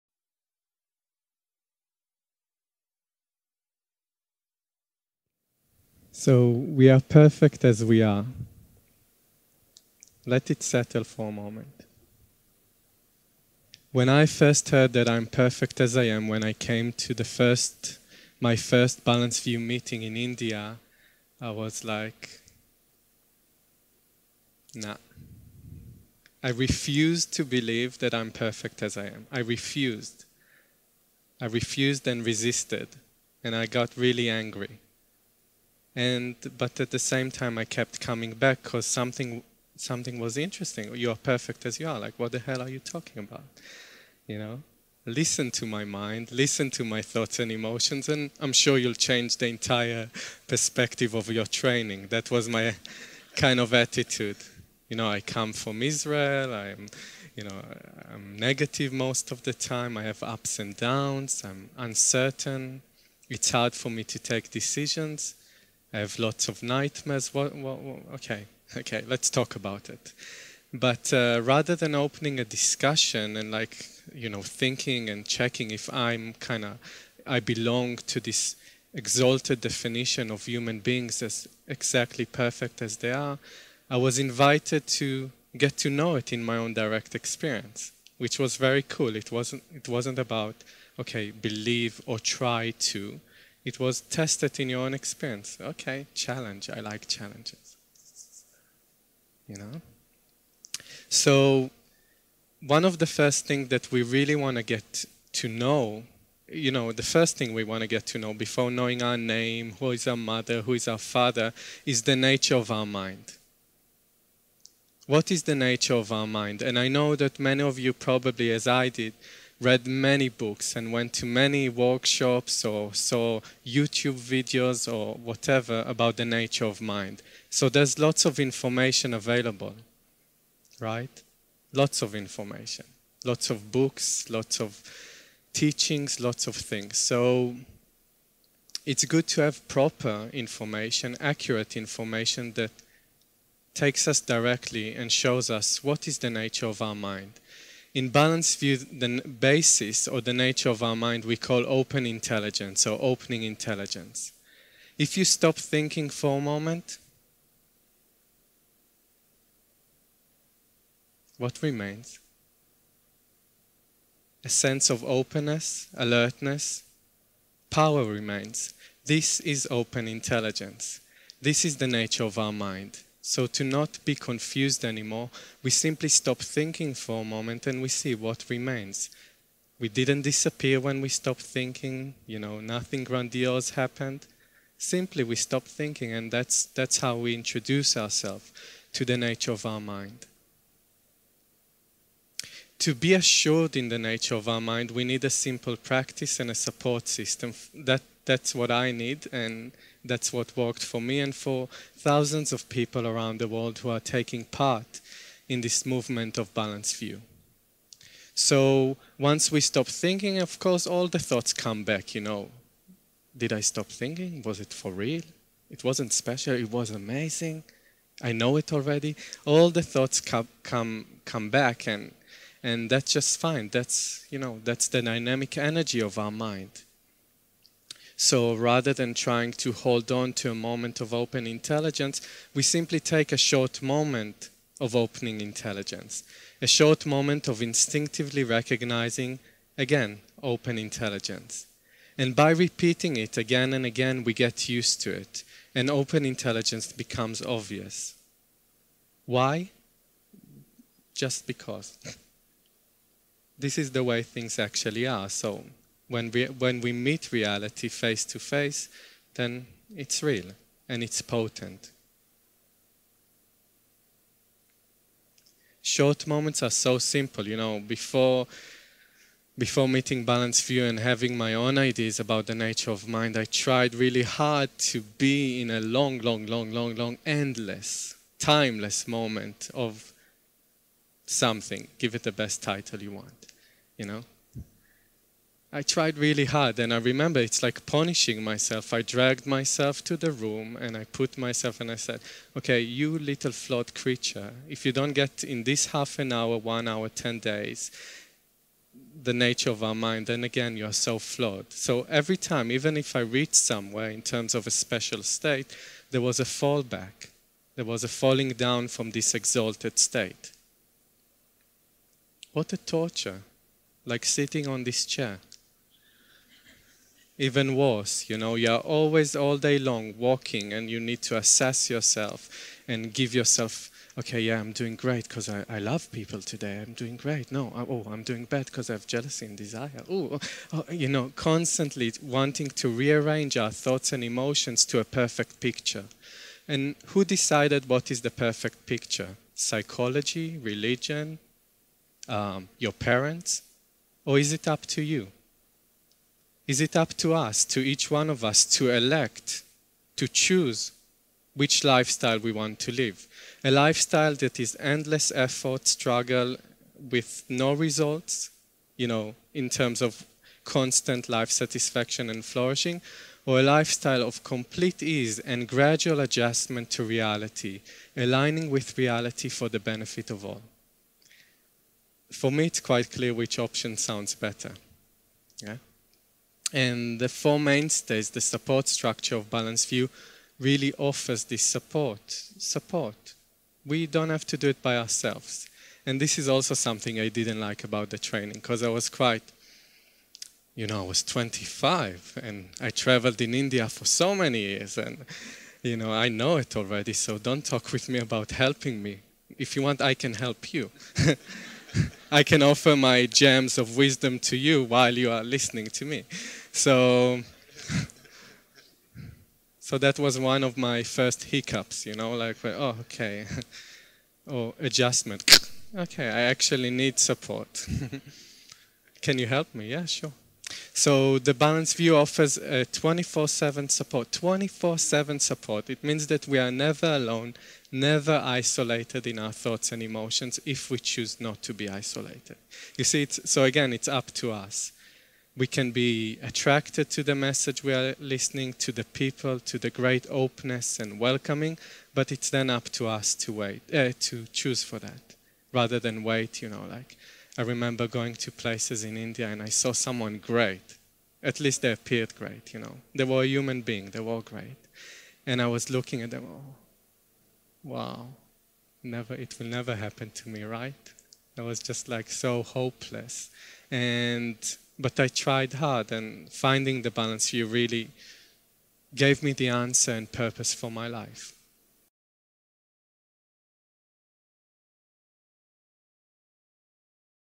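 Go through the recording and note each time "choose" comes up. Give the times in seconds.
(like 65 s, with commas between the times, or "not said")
350 s, 430 s, 444 s.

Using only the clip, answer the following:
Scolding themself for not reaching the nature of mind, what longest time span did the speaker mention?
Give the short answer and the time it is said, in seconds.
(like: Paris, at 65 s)
10 days, at 297 s.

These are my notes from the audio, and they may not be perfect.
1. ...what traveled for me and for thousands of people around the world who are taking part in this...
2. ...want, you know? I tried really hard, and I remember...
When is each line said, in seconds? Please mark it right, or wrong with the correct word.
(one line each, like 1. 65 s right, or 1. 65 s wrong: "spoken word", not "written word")
1. 200 s wrong: "worked", not "traveled"
2. 283 s right.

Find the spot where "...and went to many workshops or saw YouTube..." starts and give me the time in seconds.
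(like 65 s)
120 s.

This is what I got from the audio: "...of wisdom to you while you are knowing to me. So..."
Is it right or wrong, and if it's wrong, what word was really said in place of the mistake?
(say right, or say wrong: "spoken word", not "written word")
wrong: "listening", not "knowing".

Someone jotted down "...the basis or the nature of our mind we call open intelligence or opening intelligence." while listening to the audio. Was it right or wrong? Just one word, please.
right.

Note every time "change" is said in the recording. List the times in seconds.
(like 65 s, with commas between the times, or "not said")
48 s.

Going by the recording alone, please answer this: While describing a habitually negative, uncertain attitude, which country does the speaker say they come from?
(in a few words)
Israel.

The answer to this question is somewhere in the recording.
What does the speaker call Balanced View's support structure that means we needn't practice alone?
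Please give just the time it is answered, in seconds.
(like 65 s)
377 s.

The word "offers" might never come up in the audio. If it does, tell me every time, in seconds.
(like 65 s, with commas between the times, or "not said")
380 s, 402 s, 422 s.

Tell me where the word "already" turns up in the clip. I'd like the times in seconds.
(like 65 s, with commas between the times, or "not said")
218 s, 396 s.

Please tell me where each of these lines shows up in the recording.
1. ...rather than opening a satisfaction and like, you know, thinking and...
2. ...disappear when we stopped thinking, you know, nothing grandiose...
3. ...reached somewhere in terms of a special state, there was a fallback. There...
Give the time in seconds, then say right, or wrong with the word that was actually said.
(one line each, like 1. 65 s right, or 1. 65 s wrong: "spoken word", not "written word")
1. 71 s wrong: "discussion", not "satisfaction"
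2. 180 s right
3. 303 s right.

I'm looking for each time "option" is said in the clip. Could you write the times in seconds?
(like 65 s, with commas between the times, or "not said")
373 s.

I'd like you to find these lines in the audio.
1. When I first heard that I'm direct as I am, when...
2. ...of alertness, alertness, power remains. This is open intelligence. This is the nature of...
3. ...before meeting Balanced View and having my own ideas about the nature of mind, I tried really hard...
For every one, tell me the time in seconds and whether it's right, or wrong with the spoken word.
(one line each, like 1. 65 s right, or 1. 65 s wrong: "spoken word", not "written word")
1. 13 s wrong: "perfect", not "direct"
2. 164 s wrong: "openness", not "alertness"
3. 269 s right.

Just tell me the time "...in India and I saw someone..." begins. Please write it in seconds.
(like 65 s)
449 s.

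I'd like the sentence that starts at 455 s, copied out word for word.
And I was looking at them, oh, wow, never, it will never happen to me, right?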